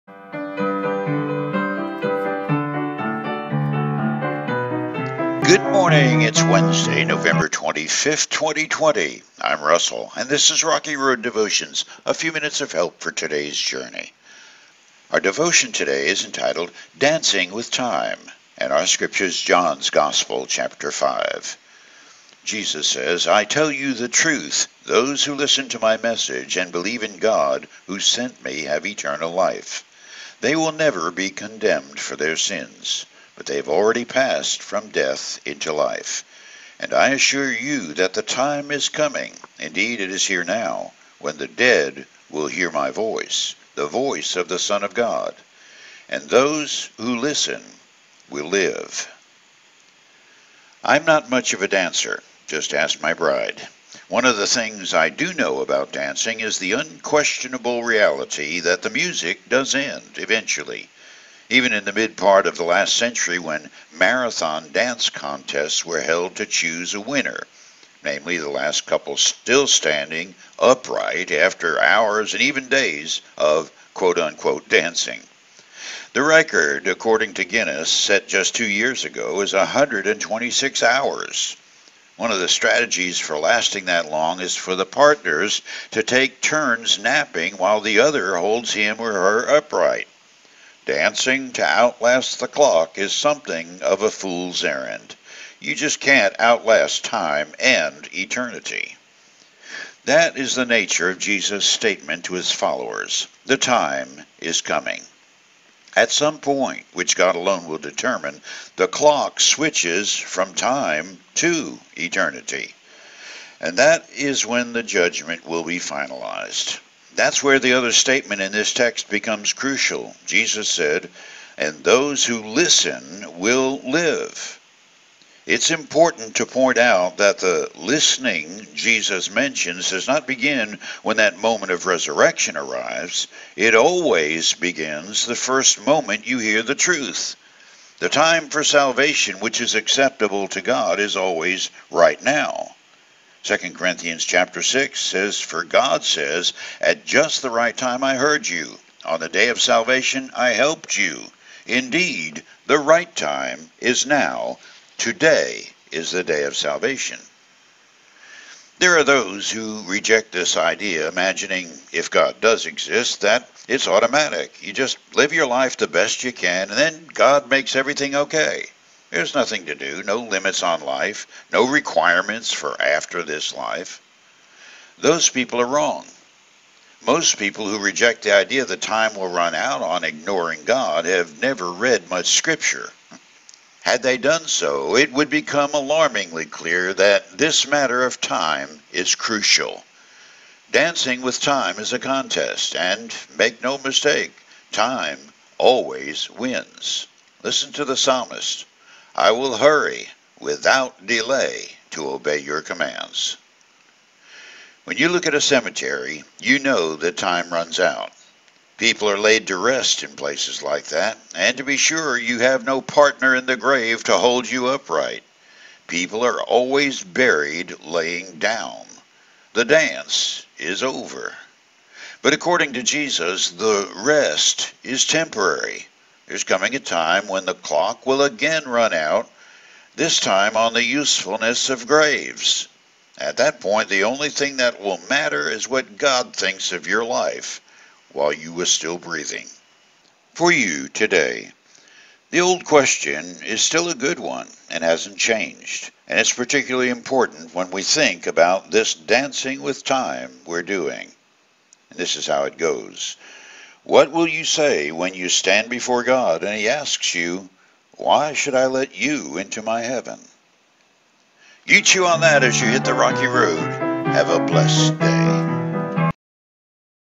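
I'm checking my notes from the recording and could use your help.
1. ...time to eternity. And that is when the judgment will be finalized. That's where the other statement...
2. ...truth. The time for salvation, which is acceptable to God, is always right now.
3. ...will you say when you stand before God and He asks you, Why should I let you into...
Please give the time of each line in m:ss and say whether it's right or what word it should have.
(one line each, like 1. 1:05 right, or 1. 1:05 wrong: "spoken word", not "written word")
1. 1:50 right
2. 2:16 right
3. 4:14 right.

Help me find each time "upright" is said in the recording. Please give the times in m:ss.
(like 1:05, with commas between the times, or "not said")
1:10, 1:29, 3:34.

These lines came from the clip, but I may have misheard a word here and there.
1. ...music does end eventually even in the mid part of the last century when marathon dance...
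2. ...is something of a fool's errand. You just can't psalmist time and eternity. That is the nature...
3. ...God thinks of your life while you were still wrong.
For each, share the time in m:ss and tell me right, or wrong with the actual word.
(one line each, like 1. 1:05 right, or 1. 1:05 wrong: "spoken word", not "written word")
1. 0:58 right
2. 1:32 wrong: "outlast", not "psalmist"
3. 3:55 wrong: "breathing", not "wrong".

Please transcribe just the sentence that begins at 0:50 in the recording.
I'm not much of a dancer, just ask my bride.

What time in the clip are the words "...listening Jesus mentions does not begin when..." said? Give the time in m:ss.
2:07.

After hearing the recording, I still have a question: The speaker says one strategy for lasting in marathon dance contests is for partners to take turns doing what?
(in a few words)
Napping.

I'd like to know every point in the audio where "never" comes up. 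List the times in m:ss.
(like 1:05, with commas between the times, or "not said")
0:30, 3:01.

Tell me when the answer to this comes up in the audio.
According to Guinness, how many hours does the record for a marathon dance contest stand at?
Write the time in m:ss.
1:19.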